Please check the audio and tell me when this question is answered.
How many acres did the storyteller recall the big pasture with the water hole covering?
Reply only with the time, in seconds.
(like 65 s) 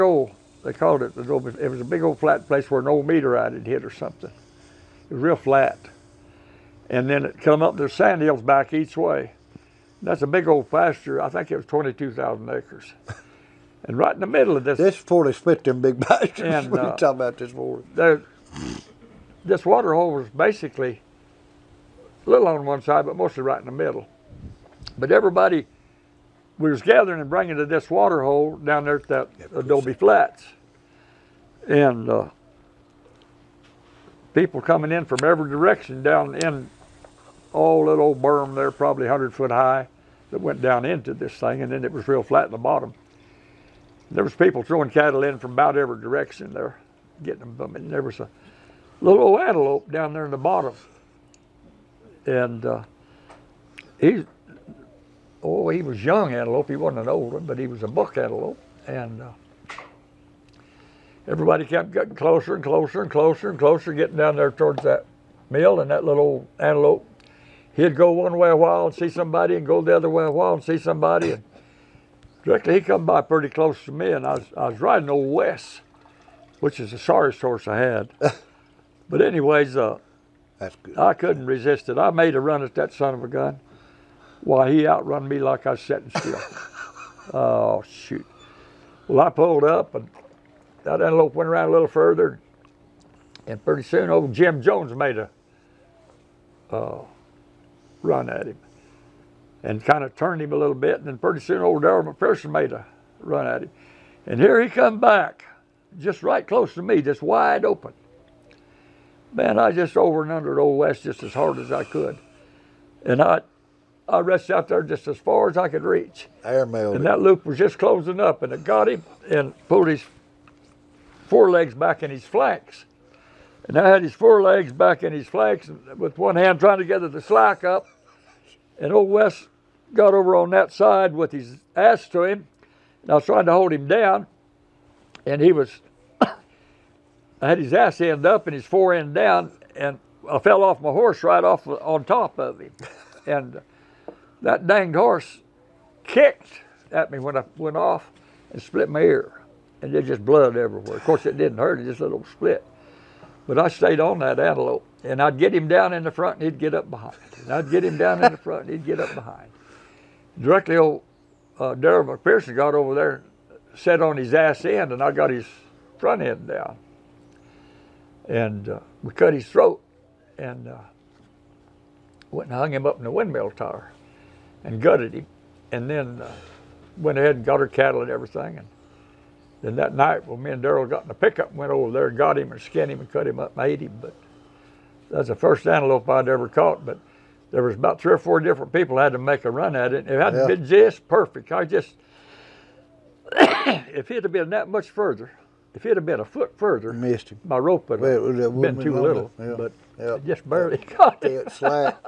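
11 s.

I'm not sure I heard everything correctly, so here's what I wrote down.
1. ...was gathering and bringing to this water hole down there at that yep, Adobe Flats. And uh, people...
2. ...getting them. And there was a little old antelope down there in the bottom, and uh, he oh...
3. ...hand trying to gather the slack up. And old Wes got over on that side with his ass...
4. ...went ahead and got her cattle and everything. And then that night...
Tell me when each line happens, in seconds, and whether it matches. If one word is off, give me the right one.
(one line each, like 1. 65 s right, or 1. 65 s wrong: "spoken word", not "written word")
1. 26 s right
2. 47 s right
3. 126 s right
4. 176 s right.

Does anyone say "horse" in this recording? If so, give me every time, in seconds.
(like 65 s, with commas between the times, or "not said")
77 s, 140 s, 144 s.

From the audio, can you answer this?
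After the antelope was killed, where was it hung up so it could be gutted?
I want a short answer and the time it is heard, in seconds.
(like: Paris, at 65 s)
the windmill tower, at 173 s.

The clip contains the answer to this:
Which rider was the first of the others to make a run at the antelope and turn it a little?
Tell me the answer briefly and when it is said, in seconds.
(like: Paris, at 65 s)
Jim Jones, at 94 s.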